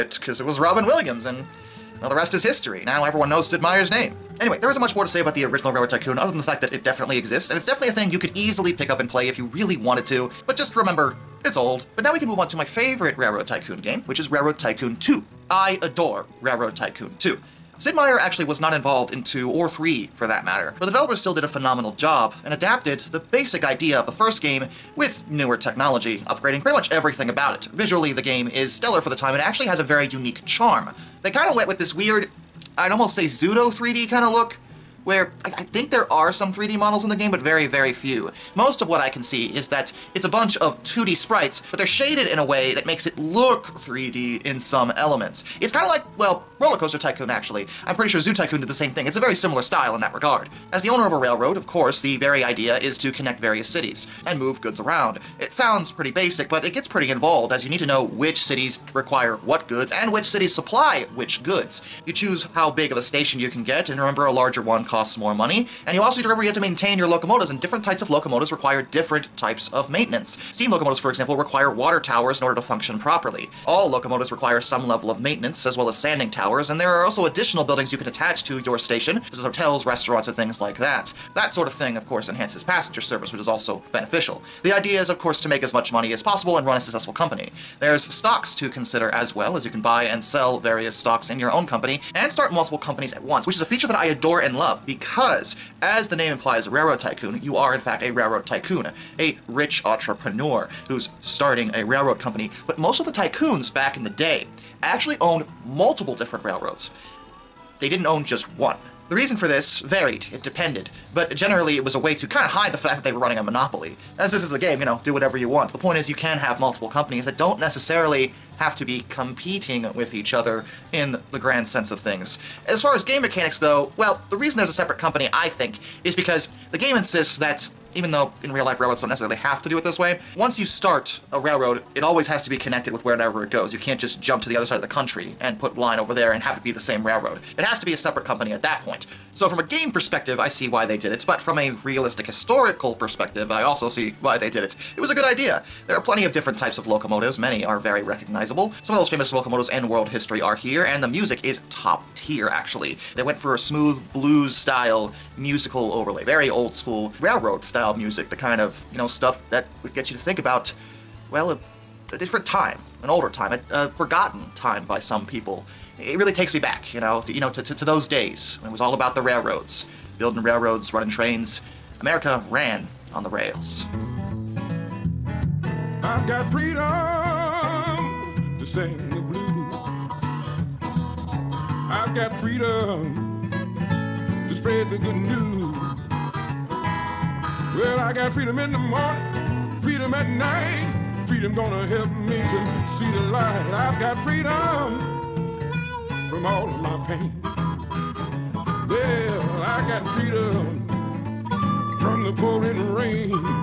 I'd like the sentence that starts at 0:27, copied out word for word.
Visually, the game is stellar for the time.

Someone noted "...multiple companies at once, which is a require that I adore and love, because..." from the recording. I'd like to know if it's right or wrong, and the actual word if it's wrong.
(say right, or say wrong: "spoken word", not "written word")
wrong: "feature", not "require".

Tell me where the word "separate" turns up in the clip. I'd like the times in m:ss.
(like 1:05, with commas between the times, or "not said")
2:04, 2:17.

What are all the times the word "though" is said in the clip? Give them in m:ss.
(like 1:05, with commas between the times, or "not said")
2:03, 2:08.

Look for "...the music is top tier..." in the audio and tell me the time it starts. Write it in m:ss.
2:31.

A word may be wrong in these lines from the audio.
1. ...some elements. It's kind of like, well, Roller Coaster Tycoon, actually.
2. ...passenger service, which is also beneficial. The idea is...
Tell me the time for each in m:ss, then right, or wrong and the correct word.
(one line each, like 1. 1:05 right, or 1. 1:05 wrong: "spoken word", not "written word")
1. 0:44 right
2. 1:22 right.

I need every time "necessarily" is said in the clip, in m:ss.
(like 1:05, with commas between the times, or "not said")
1:57, 2:09.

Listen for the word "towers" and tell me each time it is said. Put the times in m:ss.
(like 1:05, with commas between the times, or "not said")
1:11, 1:16.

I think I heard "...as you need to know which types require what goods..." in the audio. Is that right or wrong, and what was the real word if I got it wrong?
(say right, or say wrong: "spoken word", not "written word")
wrong: "cities", not "types".